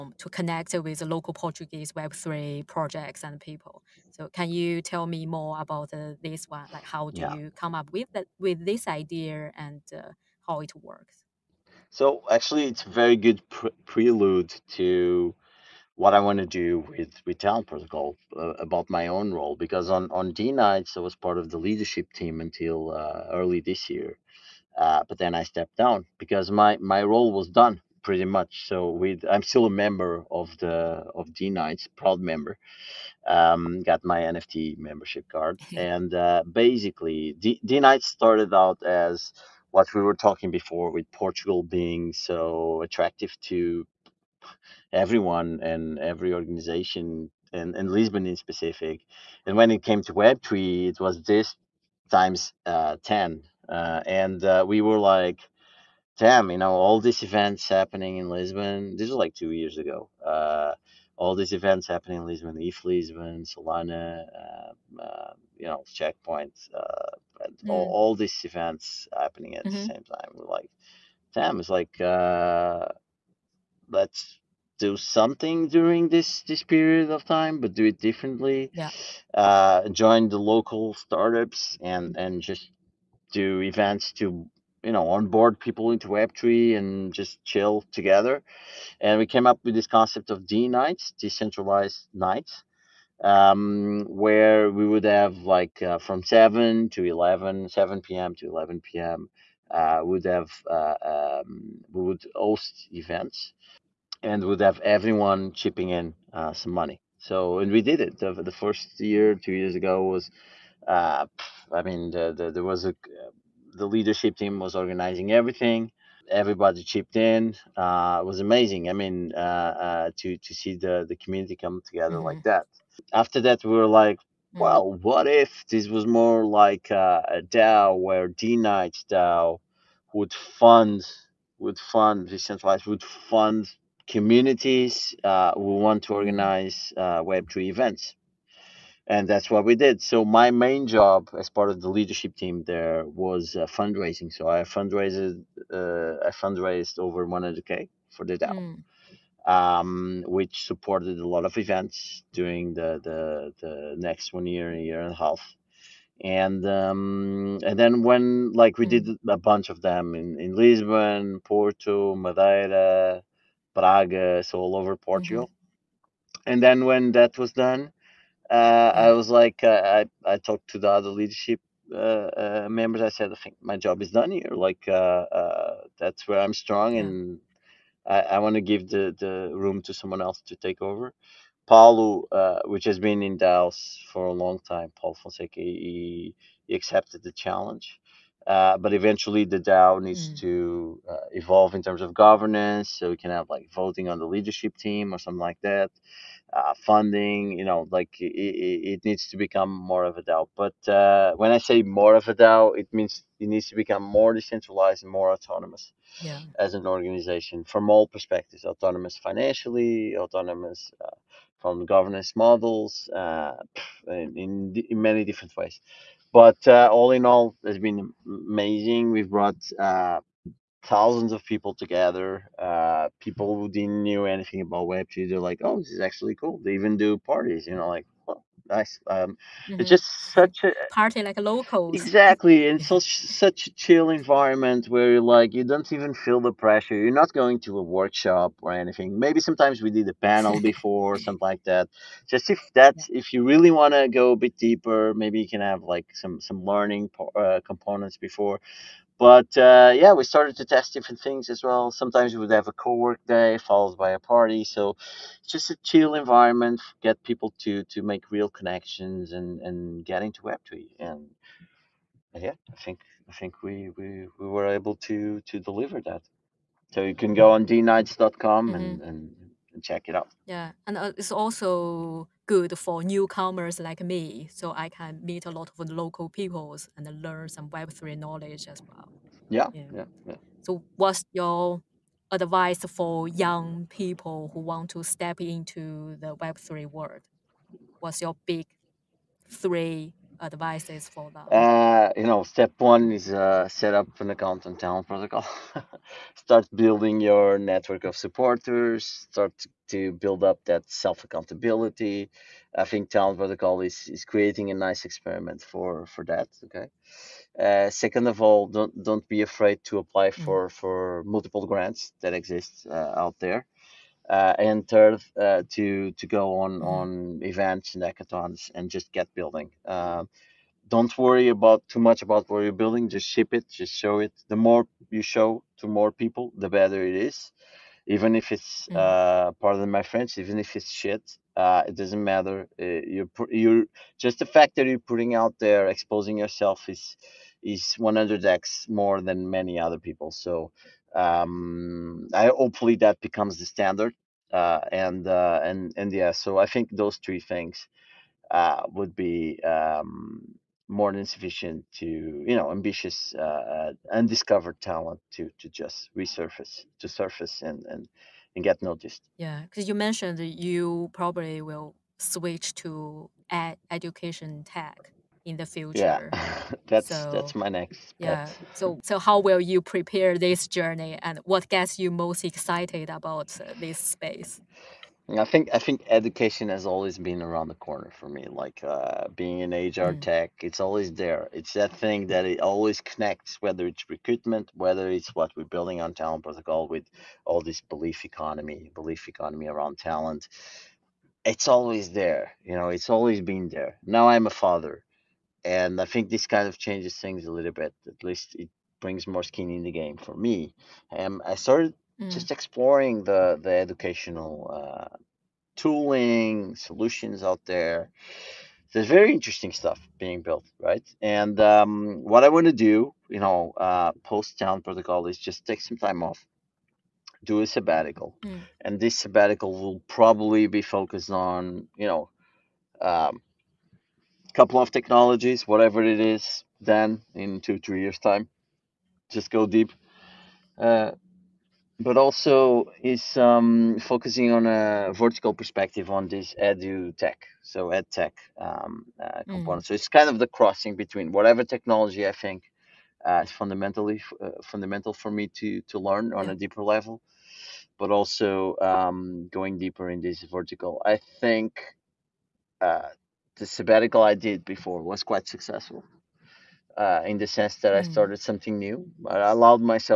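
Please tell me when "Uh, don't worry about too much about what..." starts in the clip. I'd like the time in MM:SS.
05:19.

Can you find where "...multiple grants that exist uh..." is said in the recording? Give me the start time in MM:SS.
05:11.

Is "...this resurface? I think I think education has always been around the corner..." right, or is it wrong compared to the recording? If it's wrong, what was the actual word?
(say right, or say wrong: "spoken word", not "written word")
wrong: "space", not "resurface".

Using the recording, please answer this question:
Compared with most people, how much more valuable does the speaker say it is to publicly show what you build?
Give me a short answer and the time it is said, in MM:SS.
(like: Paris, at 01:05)
100x, at 05:37.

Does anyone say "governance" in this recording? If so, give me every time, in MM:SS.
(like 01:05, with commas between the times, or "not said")
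03:12, 03:31.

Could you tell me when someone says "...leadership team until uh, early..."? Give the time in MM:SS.
00:21.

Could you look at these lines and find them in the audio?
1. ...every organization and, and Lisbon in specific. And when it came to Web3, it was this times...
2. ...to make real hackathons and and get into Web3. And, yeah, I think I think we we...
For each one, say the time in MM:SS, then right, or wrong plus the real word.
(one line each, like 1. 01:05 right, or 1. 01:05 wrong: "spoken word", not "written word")
1. 00:45 right
2. 04:17 wrong: "connections", not "hackathons".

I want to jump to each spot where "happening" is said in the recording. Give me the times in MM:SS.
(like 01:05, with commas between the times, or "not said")
00:57, 01:01, 01:09.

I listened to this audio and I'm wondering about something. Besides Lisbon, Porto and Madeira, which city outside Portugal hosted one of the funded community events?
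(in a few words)
Prague.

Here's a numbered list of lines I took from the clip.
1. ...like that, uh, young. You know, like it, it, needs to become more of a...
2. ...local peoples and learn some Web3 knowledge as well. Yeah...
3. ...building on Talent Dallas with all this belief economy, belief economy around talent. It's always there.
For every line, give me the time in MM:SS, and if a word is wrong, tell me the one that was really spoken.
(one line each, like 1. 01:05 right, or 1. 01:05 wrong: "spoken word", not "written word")
1. 03:15 wrong: "funding", not "young"
2. 04:35 right
3. 06:25 wrong: "Protocol", not "Dallas".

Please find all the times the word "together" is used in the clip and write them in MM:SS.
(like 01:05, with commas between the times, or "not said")
01:27, 02:01, 03:41.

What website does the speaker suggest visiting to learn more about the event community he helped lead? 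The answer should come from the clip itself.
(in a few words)
dnights.com.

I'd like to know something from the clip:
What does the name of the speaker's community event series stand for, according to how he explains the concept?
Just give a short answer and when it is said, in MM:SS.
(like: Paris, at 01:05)
Decentralized nights, at 01:31.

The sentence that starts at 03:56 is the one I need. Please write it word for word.
You're not going to a workshop or anything.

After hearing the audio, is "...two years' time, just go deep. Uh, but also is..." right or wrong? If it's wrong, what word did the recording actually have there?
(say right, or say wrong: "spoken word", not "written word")
wrong: "three", not "two".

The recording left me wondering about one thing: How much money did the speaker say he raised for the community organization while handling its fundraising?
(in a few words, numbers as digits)
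Over 100K.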